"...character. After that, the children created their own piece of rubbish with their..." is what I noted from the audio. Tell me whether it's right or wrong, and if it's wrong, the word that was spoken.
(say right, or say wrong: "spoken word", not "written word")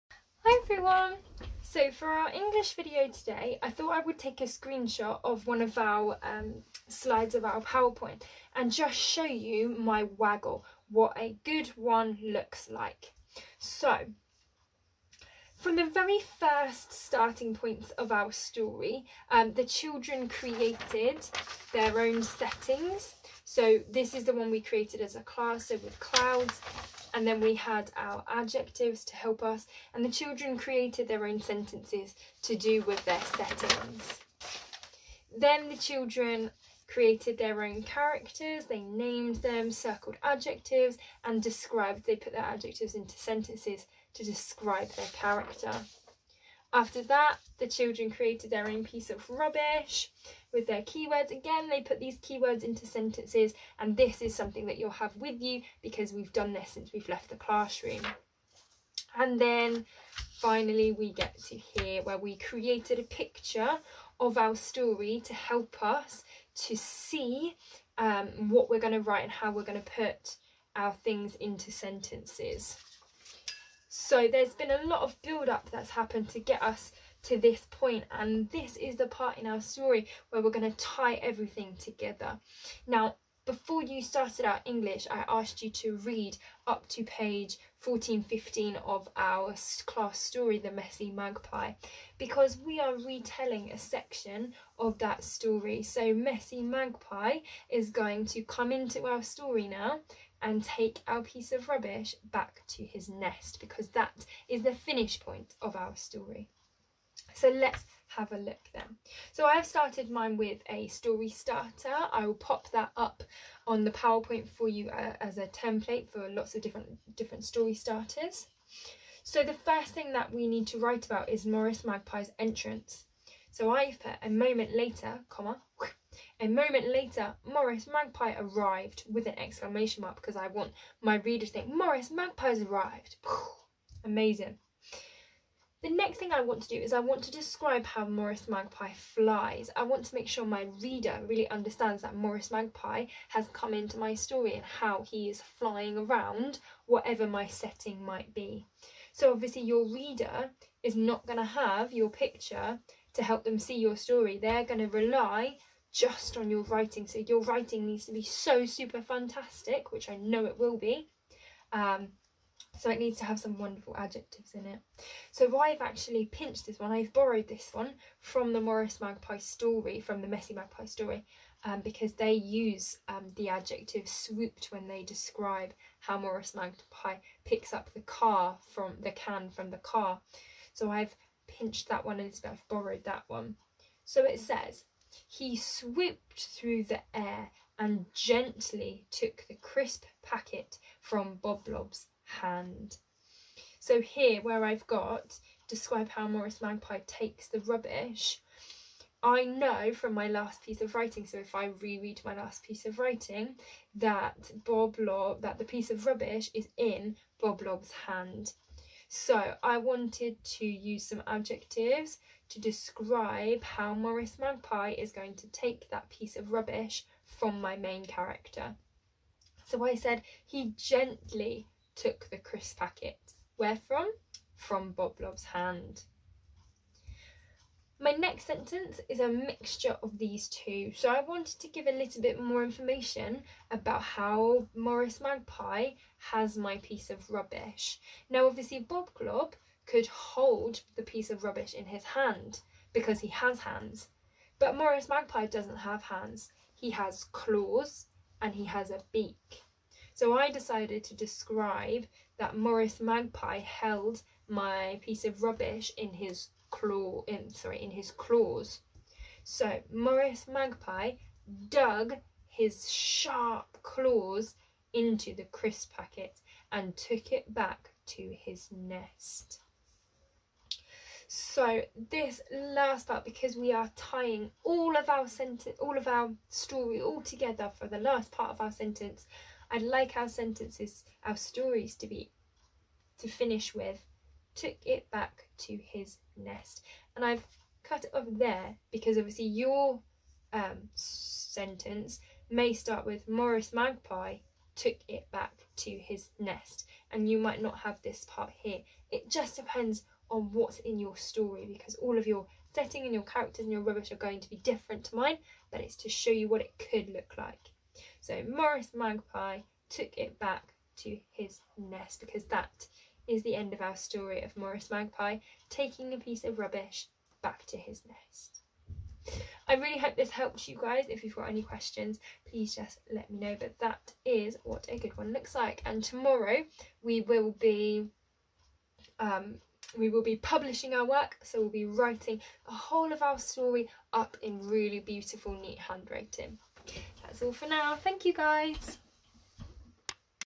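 right.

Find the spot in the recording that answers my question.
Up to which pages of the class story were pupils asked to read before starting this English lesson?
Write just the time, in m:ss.
1:27.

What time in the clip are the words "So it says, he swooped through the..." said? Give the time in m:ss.
3:04.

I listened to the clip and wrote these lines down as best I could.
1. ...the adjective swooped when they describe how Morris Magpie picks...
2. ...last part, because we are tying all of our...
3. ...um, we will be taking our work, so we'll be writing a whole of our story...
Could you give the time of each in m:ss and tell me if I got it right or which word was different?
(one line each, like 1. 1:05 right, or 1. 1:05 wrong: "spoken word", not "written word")
1. 2:53 right
2. 4:32 right
3. 5:29 wrong: "publishing", not "taking".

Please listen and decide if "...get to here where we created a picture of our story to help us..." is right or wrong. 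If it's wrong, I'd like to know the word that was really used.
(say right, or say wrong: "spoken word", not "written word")
right.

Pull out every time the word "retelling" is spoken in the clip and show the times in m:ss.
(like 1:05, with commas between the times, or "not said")
1:32.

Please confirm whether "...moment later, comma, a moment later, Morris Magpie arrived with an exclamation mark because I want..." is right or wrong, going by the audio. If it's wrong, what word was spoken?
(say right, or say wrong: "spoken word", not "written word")
right.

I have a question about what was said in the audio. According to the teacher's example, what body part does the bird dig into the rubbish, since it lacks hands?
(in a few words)
sharp claws.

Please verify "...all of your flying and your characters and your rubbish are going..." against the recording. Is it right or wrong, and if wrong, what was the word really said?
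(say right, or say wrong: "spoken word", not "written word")
wrong: "setting", not "flying".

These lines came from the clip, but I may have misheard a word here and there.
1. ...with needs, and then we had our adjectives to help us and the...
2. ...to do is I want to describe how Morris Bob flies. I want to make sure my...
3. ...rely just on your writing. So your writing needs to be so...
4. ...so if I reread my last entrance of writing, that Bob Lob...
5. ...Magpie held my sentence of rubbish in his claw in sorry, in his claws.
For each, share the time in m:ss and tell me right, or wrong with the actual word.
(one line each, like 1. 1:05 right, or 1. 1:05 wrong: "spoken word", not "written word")
1. 0:25 wrong: "clouds", not "needs"
2. 2:16 wrong: "Magpie", not "Bob"
3. 2:34 right
4. 3:21 wrong: "piece", not "entrance"
5. 4:13 wrong: "piece", not "sentence".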